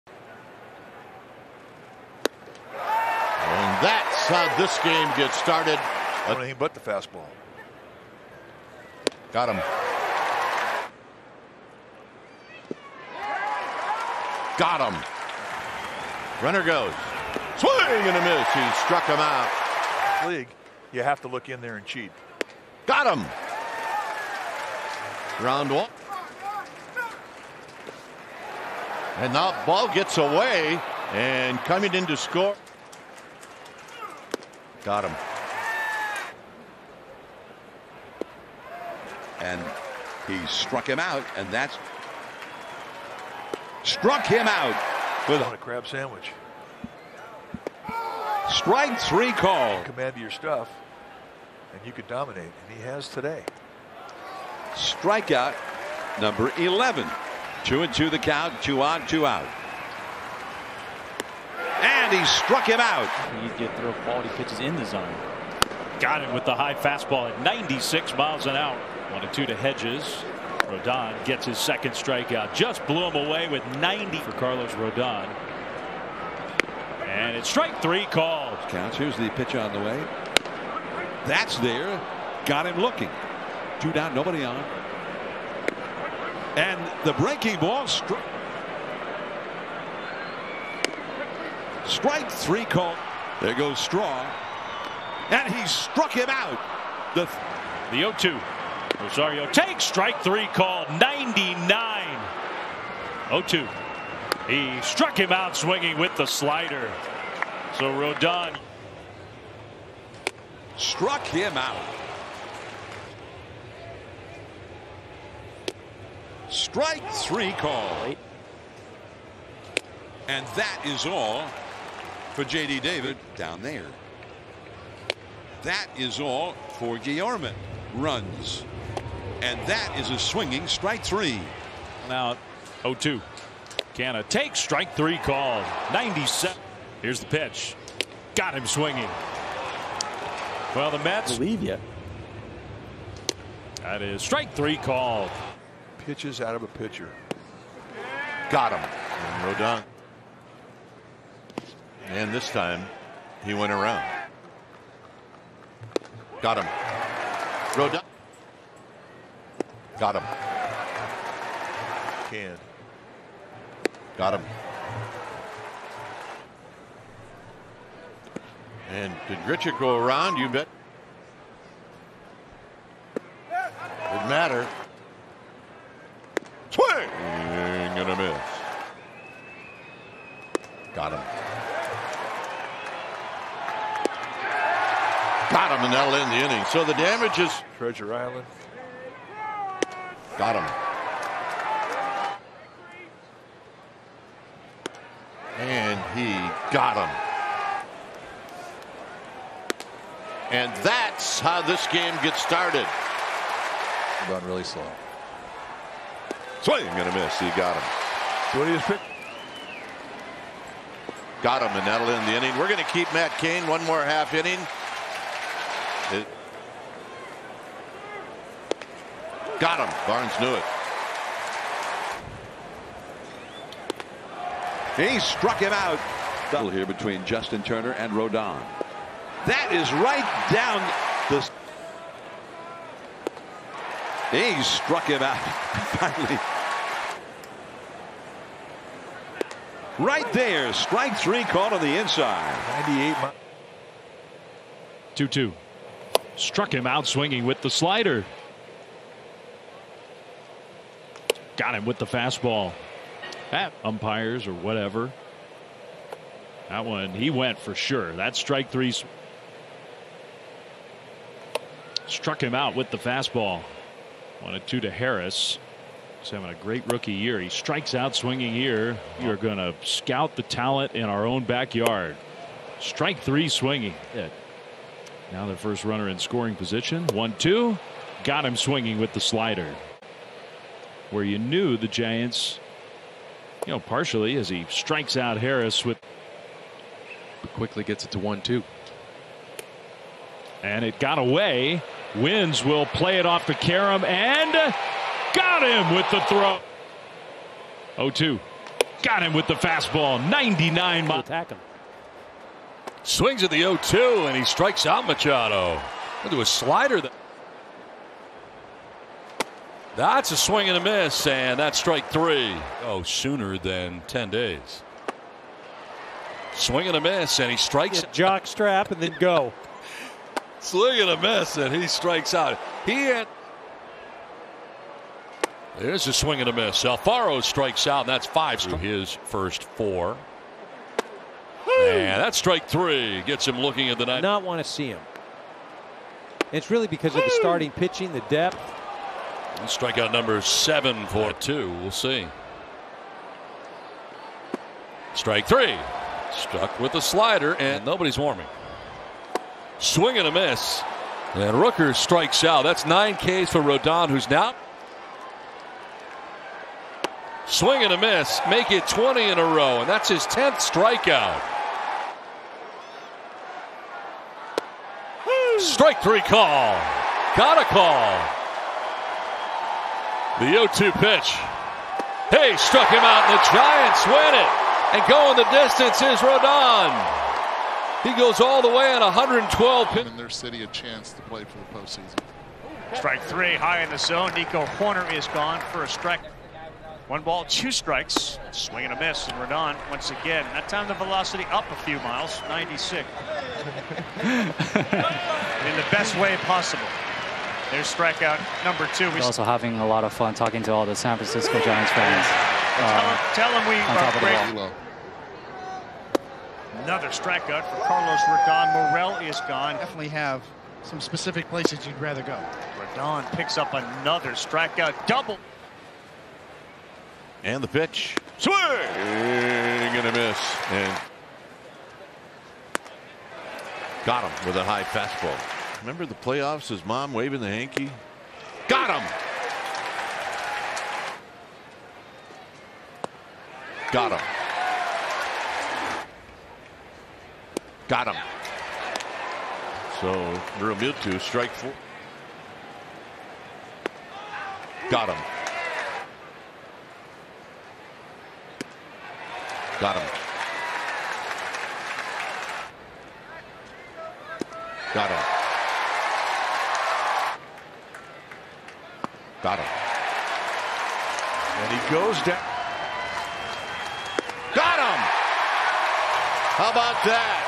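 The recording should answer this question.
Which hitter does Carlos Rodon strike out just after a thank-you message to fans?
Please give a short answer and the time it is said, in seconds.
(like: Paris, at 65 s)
Morel, at 408 s.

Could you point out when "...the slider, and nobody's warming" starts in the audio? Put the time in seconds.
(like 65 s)
346 s.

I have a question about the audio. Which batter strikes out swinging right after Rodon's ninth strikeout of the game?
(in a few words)
Rooker.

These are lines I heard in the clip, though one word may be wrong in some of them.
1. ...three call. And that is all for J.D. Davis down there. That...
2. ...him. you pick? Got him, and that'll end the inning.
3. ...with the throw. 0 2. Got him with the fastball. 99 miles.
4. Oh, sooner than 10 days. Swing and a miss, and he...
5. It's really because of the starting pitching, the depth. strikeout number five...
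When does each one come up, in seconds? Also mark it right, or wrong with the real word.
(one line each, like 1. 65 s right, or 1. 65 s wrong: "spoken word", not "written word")
1. 117 s right
2. 207 s right
3. 295 s right
4. 312 s right
5. 336 s wrong: "seven", not "five".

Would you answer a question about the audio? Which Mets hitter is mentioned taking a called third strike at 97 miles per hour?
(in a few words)
Canha.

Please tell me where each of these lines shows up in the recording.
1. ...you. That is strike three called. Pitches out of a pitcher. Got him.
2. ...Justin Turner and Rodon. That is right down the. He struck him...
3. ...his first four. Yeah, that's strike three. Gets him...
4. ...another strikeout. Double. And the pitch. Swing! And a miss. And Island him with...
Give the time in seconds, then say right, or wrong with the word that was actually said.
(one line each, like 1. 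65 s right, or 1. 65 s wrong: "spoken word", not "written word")
1. 141 s right
2. 227 s right
3. 328 s right
4. 413 s wrong: "Got", not "Island".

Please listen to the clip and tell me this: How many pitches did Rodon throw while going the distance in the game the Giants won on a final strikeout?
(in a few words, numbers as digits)
112.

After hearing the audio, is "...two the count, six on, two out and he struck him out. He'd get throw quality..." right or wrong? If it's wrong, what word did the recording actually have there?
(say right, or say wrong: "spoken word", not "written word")
wrong: "two", not "six".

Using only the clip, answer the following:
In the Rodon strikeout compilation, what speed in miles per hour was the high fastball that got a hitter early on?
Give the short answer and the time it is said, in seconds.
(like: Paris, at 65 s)
96, at 67 s.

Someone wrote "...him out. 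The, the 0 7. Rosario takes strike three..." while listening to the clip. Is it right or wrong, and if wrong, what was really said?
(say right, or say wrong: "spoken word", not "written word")
wrong: "2", not "7".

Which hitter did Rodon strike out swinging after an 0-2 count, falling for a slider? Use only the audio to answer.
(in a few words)
Machado.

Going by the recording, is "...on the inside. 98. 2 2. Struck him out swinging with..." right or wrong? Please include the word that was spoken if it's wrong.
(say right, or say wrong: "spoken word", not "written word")
right.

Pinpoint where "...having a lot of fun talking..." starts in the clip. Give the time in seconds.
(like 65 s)
399 s.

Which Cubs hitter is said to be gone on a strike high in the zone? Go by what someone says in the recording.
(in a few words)
Nico Hoerner.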